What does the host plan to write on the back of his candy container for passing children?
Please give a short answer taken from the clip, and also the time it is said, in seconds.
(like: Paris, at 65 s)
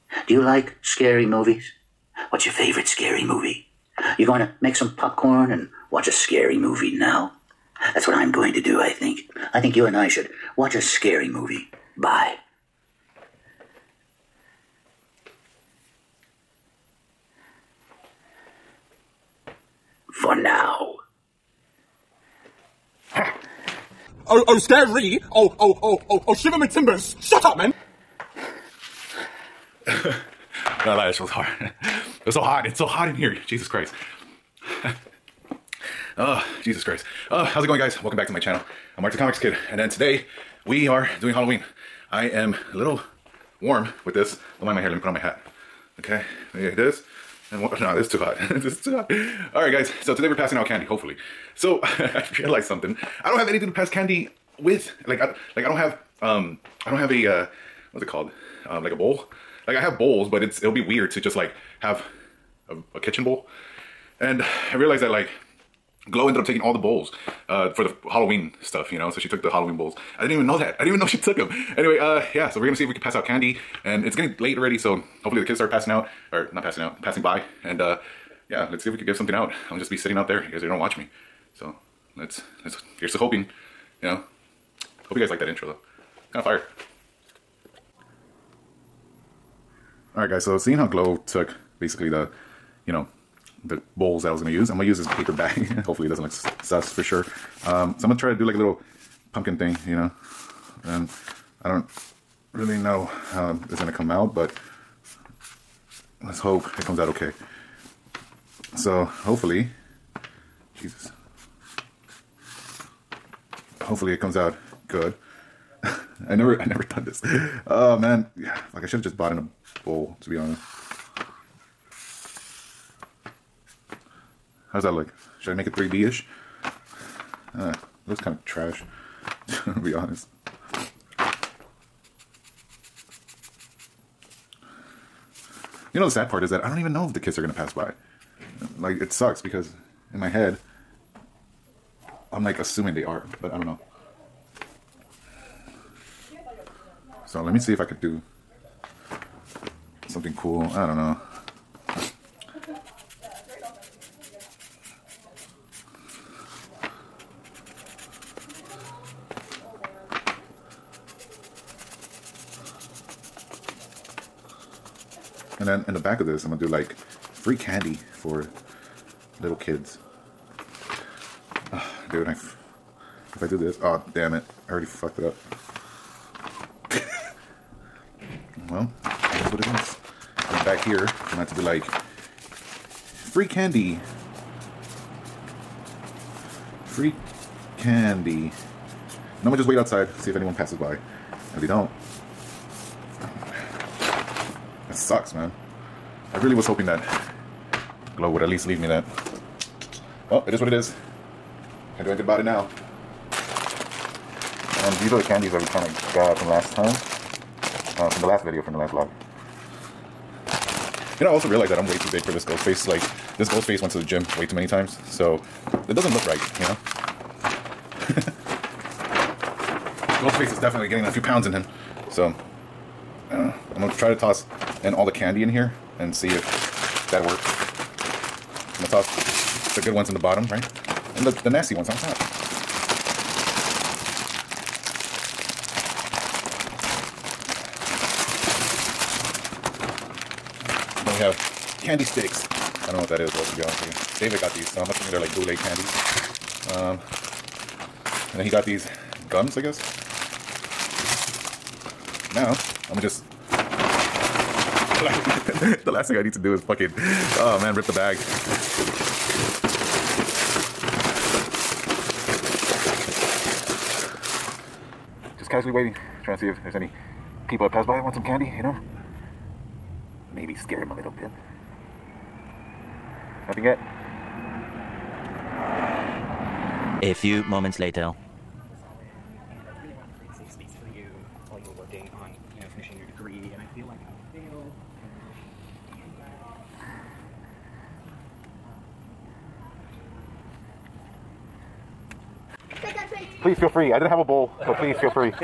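free candy for little kids, at 166 s.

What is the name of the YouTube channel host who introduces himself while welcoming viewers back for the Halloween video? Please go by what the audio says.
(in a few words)
Artsy Comics Kid.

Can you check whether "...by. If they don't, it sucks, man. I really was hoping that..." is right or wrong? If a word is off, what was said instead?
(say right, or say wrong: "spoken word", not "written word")
right.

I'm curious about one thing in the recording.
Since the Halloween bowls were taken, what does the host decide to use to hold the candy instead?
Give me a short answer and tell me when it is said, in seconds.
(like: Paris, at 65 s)
paper bag, at 95 s.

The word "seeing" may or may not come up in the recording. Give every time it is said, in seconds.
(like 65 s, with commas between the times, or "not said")
90 s.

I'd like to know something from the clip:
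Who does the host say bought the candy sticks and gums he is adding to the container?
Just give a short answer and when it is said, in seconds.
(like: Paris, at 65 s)
David, at 244 s.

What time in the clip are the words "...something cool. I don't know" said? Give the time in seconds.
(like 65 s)
150 s.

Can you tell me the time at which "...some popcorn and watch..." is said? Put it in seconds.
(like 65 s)
4 s.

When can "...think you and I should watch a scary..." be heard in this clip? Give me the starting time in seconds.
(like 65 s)
9 s.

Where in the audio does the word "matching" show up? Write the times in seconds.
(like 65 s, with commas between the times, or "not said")
not said.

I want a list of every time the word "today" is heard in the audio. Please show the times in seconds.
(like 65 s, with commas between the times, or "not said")
39 s, 50 s.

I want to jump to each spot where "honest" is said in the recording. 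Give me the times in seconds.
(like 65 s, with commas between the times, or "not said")
120 s, 129 s, 243 s.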